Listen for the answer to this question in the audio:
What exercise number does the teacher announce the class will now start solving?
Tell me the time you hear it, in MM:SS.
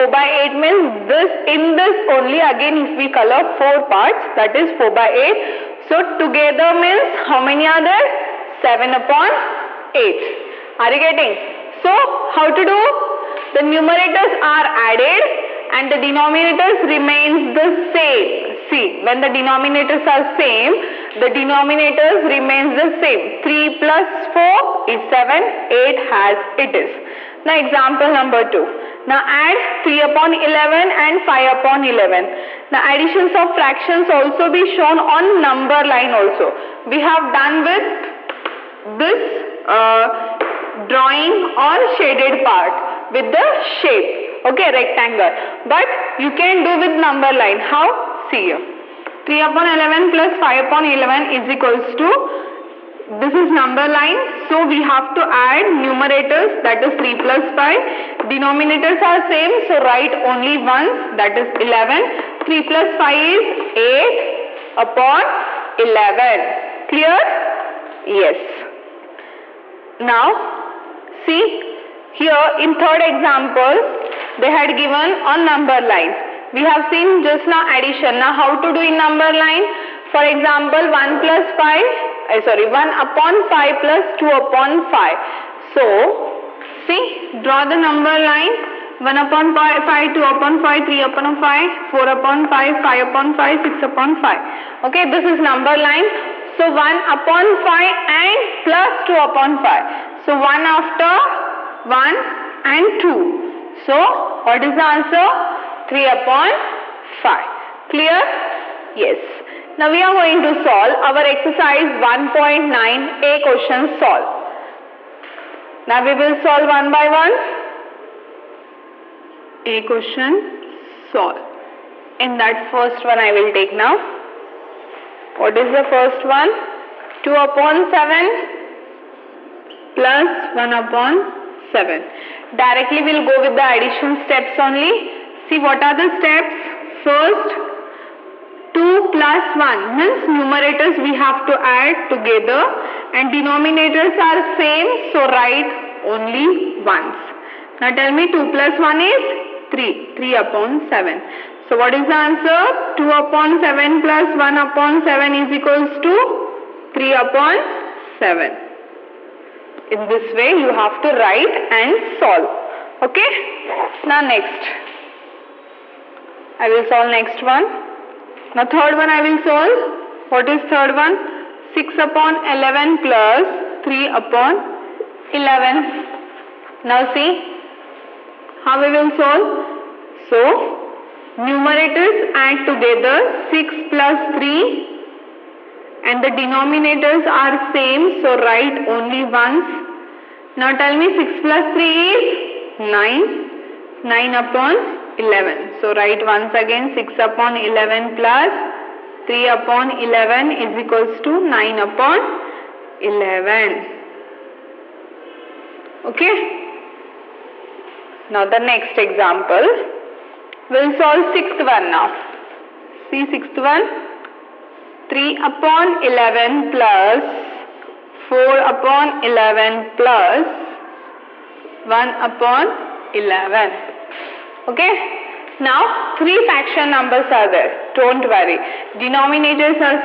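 01:51.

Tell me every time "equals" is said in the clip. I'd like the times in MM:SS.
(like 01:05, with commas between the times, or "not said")
00:51, 02:35, 03:20.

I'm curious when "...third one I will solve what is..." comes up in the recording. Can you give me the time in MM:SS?
02:48.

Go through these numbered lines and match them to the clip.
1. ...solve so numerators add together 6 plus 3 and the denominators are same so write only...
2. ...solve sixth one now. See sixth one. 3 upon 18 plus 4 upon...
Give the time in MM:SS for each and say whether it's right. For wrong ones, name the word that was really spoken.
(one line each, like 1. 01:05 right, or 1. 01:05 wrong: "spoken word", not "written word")
1. 02:59 right
2. 03:30 wrong: "11", not "18".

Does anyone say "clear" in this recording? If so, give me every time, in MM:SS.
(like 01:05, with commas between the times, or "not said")
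01:06, 01:47.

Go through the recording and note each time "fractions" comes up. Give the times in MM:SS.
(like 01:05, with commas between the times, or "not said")
00:33, 03:46.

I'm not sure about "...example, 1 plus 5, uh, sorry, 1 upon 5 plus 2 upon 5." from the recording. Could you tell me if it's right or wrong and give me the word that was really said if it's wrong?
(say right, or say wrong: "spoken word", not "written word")
right.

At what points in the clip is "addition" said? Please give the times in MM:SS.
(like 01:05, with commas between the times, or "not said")
00:32, 01:17, 02:13.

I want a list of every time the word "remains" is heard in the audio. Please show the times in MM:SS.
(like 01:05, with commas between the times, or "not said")
00:16, 00:22.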